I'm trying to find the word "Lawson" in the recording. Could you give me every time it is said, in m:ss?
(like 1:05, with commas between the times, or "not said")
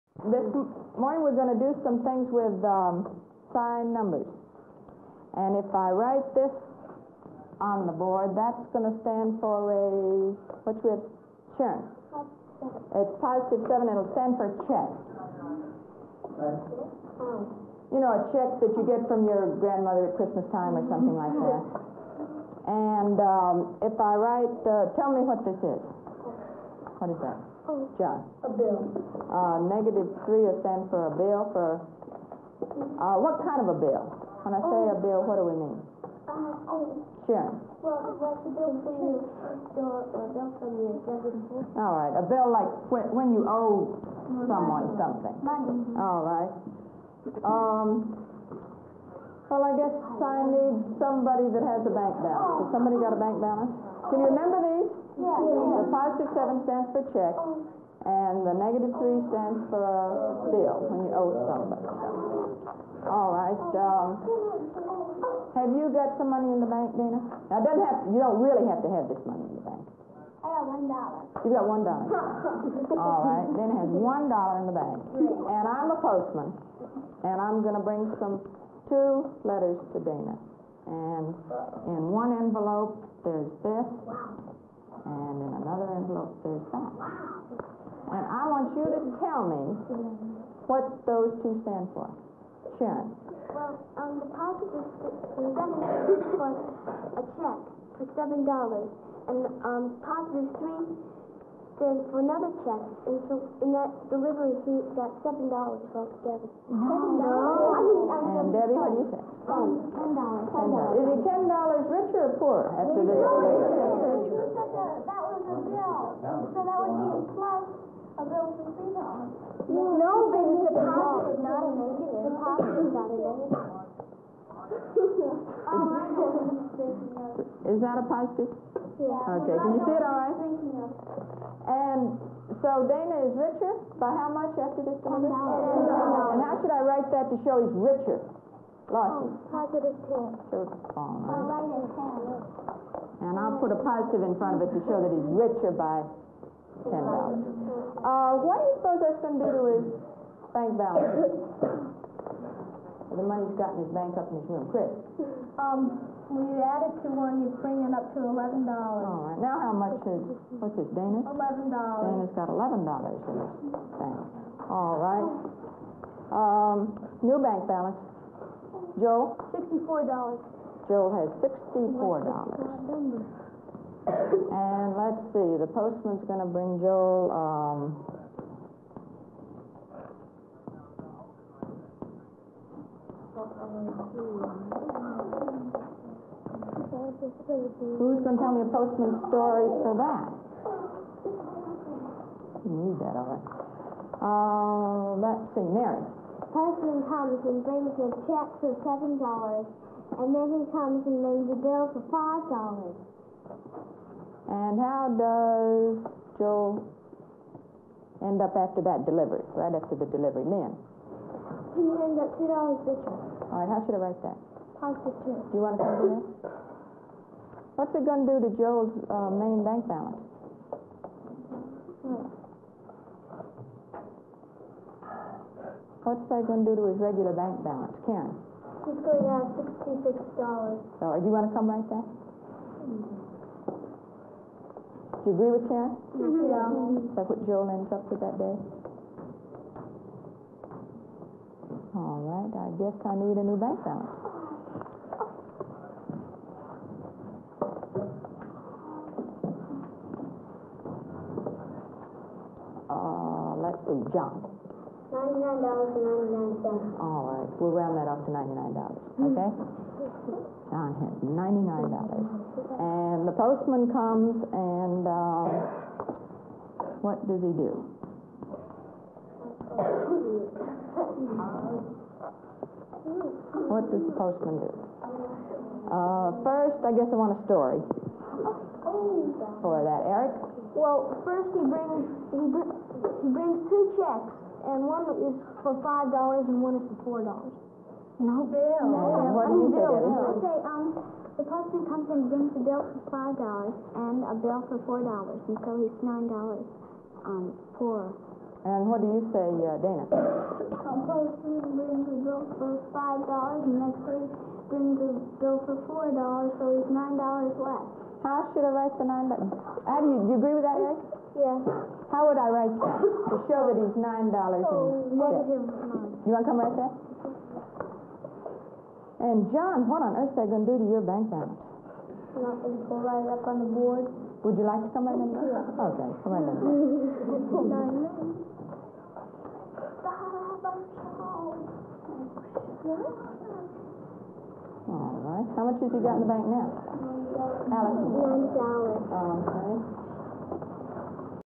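2:18.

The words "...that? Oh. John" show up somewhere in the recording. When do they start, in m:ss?
0:27.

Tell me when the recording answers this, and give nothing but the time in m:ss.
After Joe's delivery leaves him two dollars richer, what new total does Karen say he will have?
3:49.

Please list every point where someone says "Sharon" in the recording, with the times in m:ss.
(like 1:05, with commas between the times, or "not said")
0:11, 0:37, 1:32.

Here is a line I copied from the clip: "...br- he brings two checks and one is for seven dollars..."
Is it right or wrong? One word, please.
wrong.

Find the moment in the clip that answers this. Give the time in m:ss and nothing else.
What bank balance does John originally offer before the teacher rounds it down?
4:15.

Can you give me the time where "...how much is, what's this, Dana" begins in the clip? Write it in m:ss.
2:39.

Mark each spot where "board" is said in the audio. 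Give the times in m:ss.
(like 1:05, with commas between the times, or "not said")
0:07, 5:23.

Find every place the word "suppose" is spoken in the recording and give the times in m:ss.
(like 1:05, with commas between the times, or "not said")
2:28.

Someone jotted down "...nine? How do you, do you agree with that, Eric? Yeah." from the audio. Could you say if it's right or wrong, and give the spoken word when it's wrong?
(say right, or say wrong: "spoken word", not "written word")
right.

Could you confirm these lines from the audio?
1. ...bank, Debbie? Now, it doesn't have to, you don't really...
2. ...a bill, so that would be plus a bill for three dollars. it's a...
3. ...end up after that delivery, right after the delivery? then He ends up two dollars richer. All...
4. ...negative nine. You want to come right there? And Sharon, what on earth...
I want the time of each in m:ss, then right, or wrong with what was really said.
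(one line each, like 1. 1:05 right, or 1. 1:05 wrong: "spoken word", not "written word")
1. 1:06 wrong: "Dana", not "Debbie"
2. 1:55 right
3. 3:28 right
4. 5:15 wrong: "John", not "Sharon".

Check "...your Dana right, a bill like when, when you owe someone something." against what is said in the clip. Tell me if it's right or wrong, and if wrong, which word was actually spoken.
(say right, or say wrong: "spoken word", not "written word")
wrong: "All", not "Dana".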